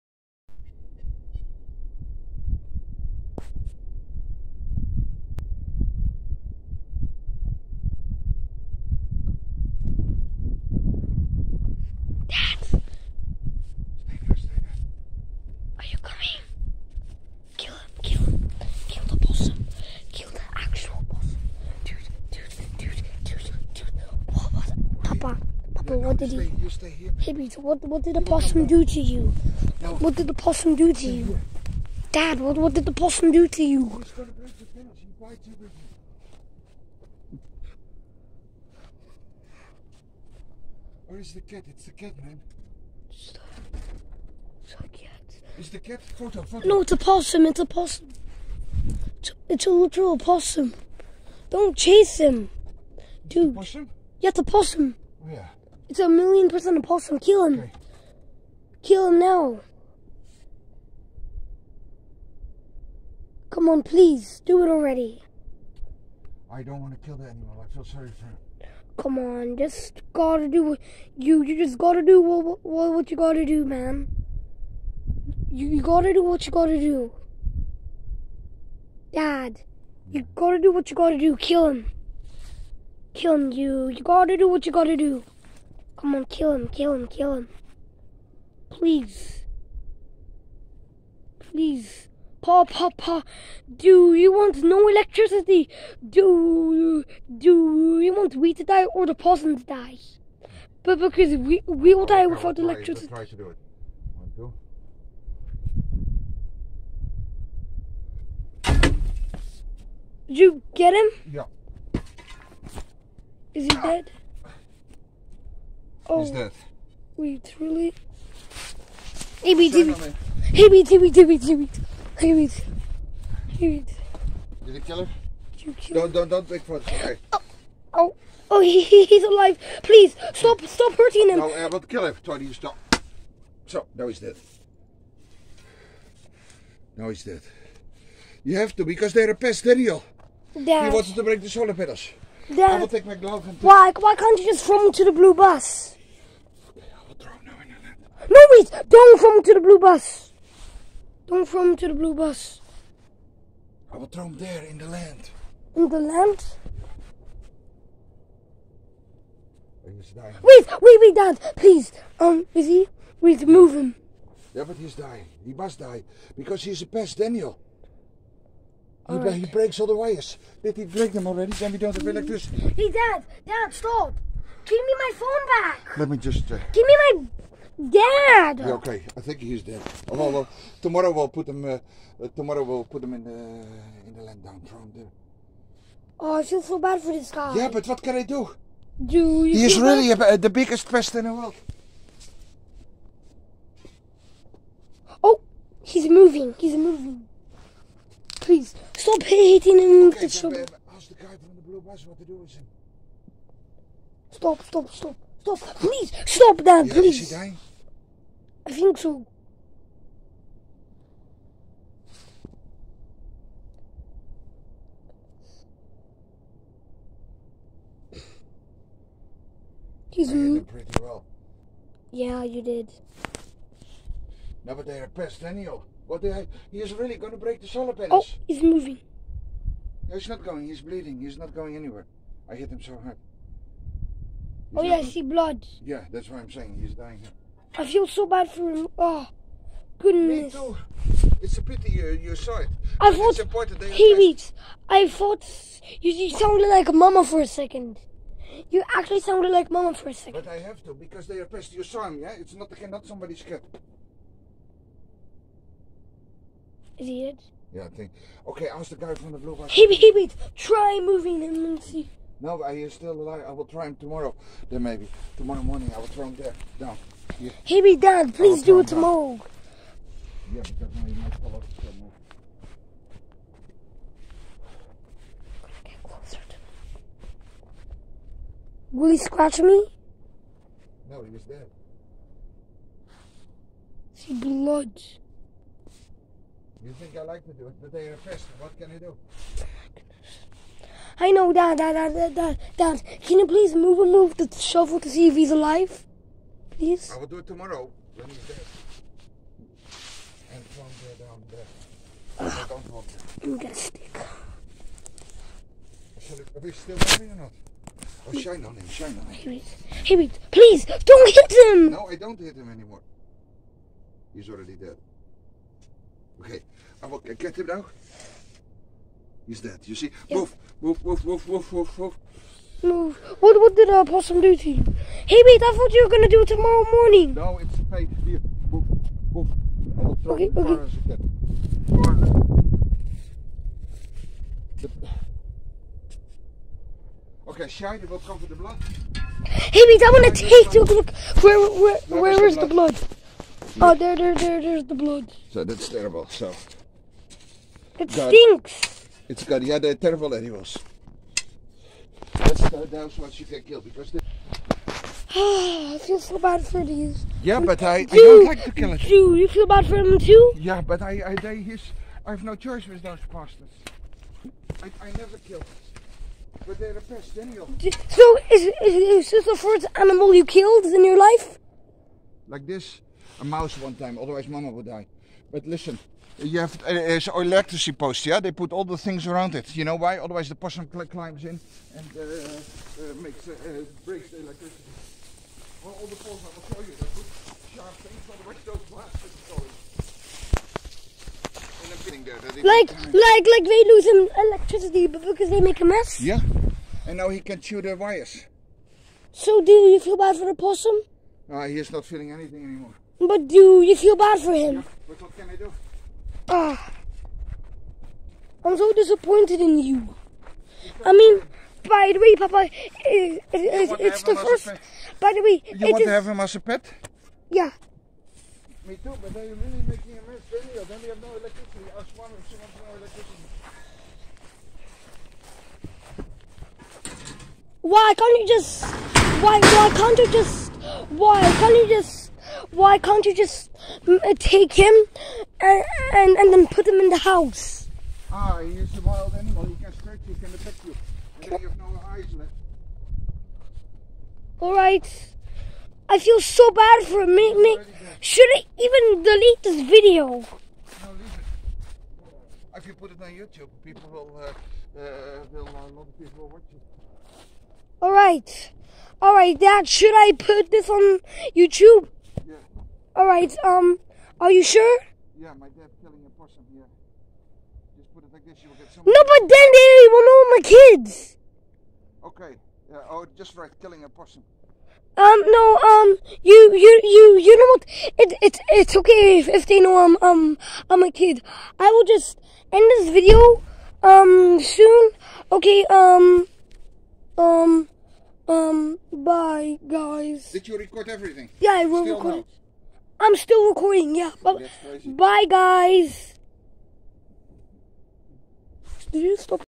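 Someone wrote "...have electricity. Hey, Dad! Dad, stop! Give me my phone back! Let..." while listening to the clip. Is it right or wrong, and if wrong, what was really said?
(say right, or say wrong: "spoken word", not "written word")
right.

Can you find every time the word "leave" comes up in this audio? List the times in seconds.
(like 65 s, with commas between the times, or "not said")
450 s.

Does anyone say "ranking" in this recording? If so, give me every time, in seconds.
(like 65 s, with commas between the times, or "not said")
not said.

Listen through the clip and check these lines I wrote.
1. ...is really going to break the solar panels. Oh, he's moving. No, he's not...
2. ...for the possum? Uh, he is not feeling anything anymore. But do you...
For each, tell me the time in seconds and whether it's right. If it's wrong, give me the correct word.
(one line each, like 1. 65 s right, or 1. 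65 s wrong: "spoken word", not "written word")
1. 226 s right
2. 400 s right.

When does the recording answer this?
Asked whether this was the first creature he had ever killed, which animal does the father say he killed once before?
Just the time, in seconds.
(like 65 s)
373 s.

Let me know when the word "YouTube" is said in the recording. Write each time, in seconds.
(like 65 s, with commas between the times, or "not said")
453 s, 461 s.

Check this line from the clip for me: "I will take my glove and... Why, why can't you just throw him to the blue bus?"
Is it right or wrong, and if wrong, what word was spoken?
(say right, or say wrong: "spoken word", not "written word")
right.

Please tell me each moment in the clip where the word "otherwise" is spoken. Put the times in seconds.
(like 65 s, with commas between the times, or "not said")
374 s, 380 s, 388 s.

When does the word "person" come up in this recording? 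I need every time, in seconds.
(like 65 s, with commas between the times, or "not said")
466 s, 474 s.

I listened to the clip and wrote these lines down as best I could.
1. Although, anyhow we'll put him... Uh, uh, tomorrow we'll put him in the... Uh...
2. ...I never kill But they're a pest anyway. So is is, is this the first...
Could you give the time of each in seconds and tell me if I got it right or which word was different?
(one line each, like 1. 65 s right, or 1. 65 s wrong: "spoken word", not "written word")
1. 180 s wrong: "tomorrow", not "anyhow"
2. 365 s right.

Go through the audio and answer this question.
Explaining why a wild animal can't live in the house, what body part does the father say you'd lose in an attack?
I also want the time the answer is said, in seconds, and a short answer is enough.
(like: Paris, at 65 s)
Eyes, at 442 s.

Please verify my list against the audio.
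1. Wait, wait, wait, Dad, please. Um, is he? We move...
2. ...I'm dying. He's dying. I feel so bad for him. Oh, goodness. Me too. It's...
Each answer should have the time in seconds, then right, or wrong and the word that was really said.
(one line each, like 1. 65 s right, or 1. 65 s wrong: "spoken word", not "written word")
1. 159 s right
2. 236 s wrong: "saying", not "dying".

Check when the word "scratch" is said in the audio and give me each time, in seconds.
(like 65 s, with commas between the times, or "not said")
279 s.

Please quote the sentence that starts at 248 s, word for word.
You actually sounded like Mama for a second.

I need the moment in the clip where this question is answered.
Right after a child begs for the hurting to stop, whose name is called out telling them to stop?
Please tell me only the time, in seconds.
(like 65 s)
132 s.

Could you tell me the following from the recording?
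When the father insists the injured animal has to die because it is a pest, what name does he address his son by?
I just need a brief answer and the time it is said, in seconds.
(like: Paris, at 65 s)
Daniel, at 167 s.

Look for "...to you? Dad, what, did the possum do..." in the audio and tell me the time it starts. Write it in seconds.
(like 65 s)
30 s.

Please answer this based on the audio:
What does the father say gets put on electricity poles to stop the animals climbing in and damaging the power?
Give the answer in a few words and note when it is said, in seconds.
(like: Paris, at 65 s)
Sharp things, at 387 s.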